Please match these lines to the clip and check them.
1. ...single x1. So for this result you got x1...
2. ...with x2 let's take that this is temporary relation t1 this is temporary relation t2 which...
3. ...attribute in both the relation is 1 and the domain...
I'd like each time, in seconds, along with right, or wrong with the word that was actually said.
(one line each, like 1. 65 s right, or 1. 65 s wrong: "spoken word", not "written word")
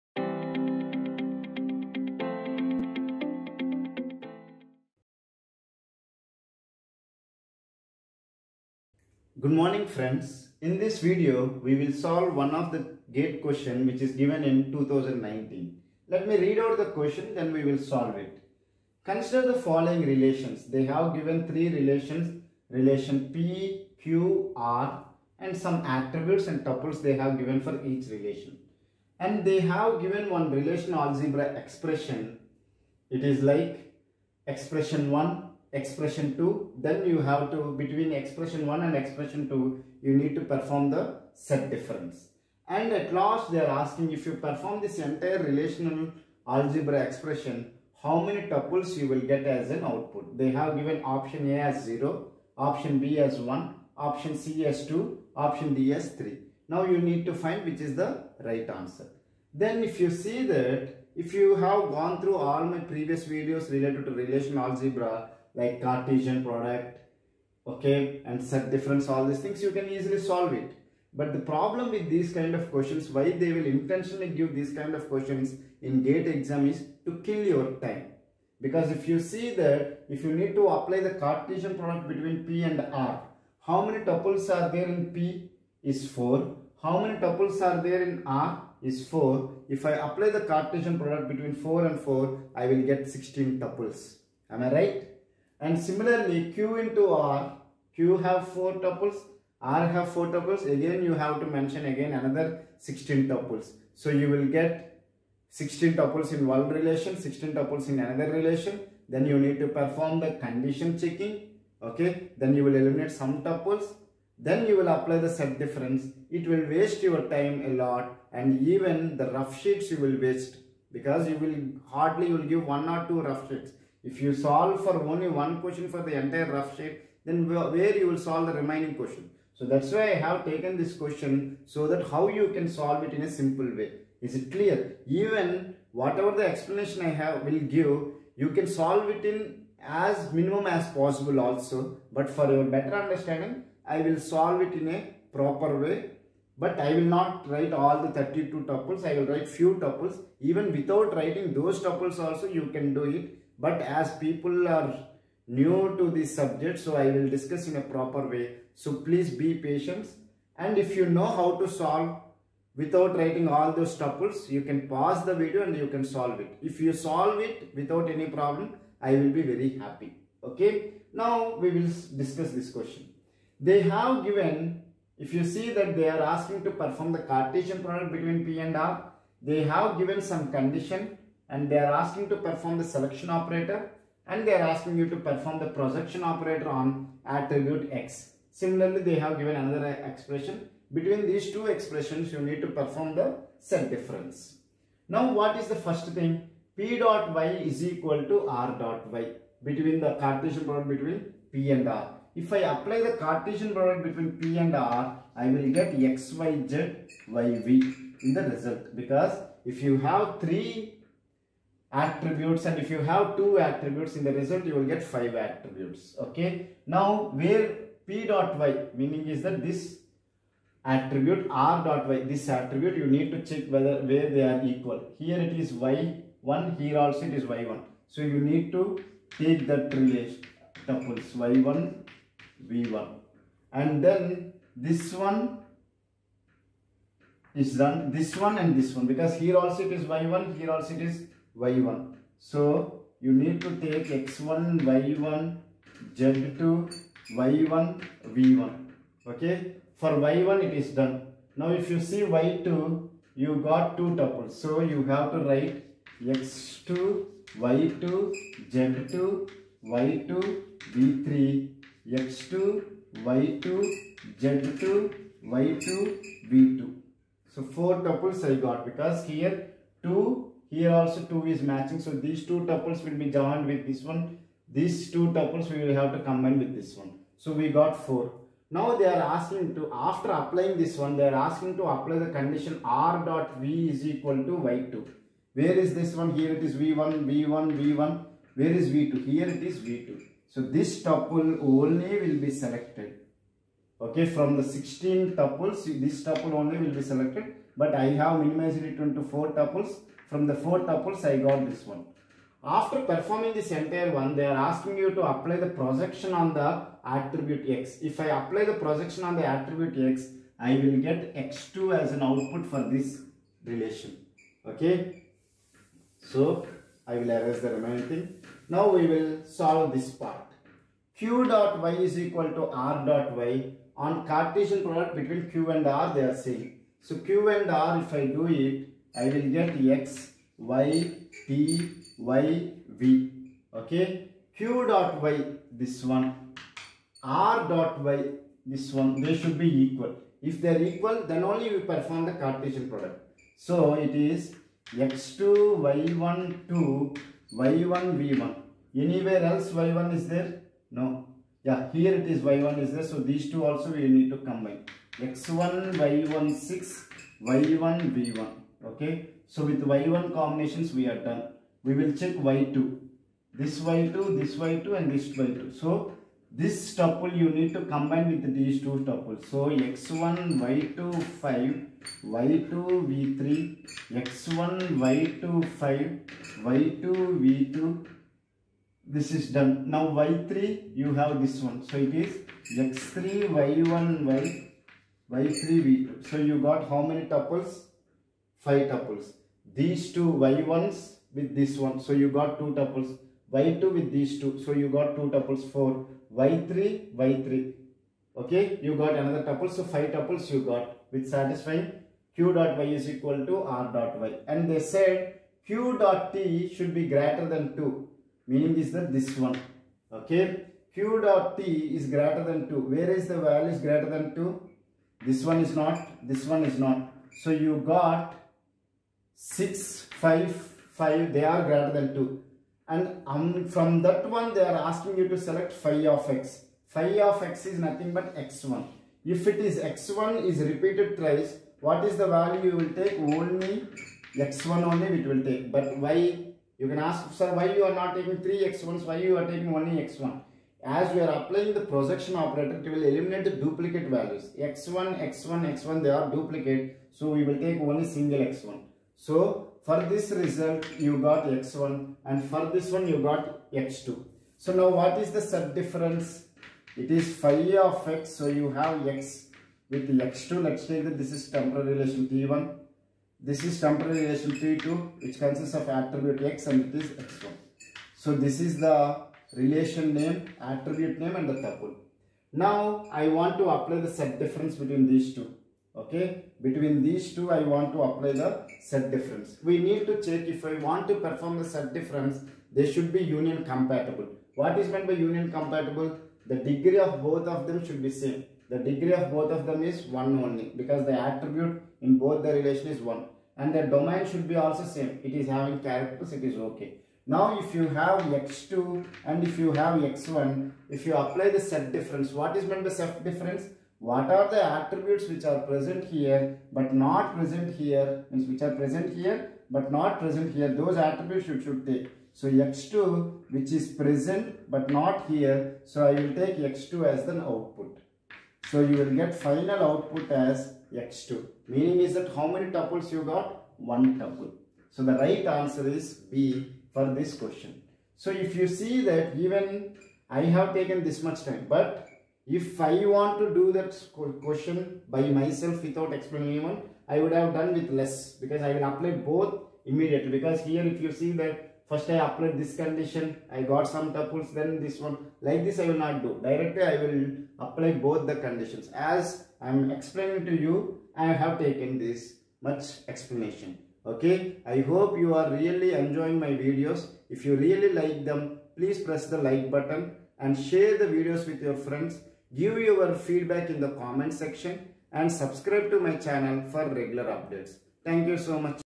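1. 448 s right
2. 459 s right
3. 491 s right.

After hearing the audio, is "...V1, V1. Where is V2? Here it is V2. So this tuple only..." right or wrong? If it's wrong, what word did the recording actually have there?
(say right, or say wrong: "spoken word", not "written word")
right.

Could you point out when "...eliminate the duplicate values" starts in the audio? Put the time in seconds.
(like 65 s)
443 s.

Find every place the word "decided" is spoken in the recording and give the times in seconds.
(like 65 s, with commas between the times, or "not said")
not said.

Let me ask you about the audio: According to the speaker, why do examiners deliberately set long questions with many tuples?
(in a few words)
To kill your time.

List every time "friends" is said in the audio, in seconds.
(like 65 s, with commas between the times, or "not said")
9 s, 561 s.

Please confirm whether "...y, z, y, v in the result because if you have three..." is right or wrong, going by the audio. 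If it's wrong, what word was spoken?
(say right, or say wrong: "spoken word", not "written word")
right.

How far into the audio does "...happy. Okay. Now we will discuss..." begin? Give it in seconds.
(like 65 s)
169 s.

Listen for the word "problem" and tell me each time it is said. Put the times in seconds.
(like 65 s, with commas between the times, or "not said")
71 s, 168 s.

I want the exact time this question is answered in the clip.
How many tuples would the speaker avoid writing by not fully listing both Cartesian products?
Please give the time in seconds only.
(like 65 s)
148 s.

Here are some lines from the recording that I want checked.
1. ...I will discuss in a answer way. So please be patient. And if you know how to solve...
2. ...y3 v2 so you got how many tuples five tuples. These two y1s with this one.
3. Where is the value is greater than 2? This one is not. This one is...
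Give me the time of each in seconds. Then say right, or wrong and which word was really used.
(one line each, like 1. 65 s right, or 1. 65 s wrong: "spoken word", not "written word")
1. 156 s wrong: "proper", not "answer"
2. 385 s right
3. 412 s right.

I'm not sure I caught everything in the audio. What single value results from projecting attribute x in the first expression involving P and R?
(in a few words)
x2.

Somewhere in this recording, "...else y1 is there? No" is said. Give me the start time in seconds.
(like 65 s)
349 s.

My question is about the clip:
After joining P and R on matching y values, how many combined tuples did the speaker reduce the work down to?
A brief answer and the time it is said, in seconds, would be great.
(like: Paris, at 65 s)
4, at 277 s.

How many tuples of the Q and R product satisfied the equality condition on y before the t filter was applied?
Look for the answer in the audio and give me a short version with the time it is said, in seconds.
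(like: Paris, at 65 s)
5, at 399 s.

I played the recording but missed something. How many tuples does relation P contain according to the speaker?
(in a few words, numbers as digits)
4.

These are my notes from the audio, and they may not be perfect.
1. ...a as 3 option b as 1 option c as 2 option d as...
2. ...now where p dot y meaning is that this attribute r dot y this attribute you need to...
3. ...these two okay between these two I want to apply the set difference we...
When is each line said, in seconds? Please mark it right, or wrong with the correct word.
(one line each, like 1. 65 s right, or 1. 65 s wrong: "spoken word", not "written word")
1. 51 s wrong: "0", not "3"
2. 216 s right
3. 475 s right.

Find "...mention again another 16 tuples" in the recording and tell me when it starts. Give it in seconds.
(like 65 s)
101 s.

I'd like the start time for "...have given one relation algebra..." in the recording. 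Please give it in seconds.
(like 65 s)
29 s.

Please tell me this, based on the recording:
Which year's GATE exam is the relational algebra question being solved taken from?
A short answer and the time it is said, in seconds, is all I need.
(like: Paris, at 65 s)
2019, at 14 s.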